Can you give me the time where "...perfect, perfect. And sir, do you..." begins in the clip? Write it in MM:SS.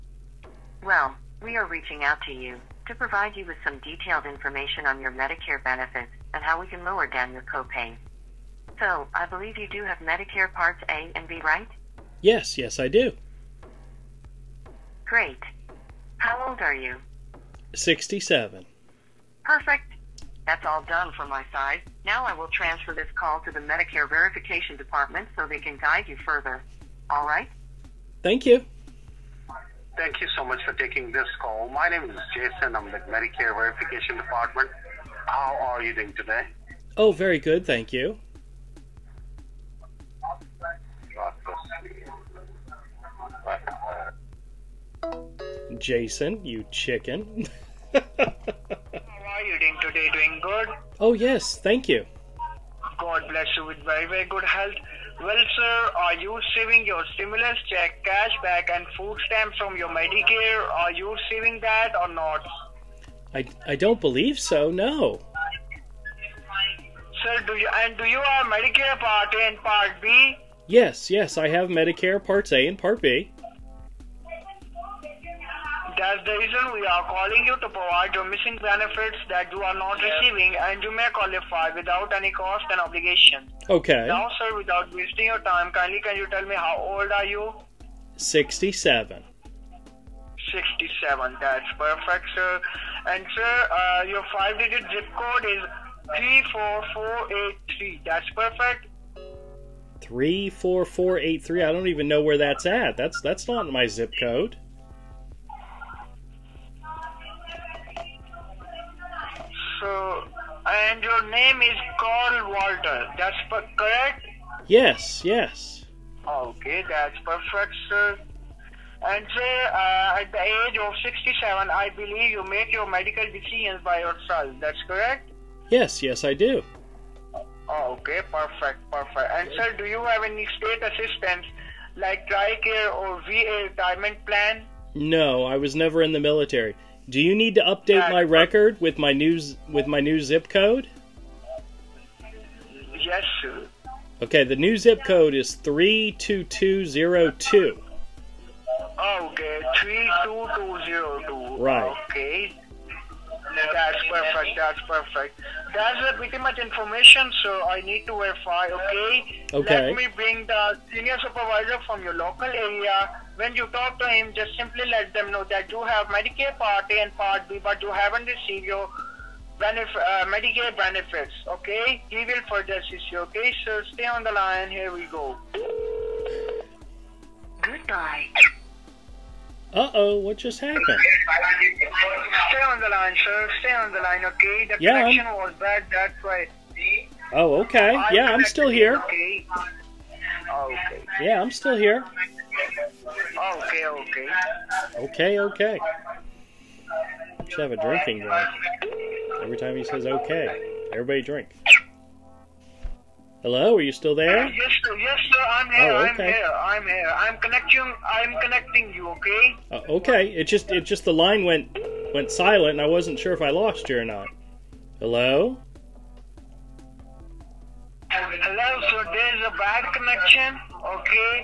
02:08.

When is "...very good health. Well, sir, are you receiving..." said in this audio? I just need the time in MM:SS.
00:54.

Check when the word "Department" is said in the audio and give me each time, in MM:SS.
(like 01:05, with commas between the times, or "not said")
00:24, 00:34.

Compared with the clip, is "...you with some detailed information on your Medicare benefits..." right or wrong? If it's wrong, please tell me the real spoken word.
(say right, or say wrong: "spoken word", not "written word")
right.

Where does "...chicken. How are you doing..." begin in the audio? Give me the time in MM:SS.
00:46.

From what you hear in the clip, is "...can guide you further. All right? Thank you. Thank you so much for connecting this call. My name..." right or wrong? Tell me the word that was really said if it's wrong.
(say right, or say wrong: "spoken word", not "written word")
wrong: "taking", not "connecting".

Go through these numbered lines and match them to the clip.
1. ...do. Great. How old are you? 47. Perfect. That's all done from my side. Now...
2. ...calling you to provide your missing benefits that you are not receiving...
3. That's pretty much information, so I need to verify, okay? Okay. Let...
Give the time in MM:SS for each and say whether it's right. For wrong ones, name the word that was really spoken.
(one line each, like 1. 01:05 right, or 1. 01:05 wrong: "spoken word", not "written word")
1. 00:12 wrong: "67", not "47"
2. 01:17 right
3. 02:35 right.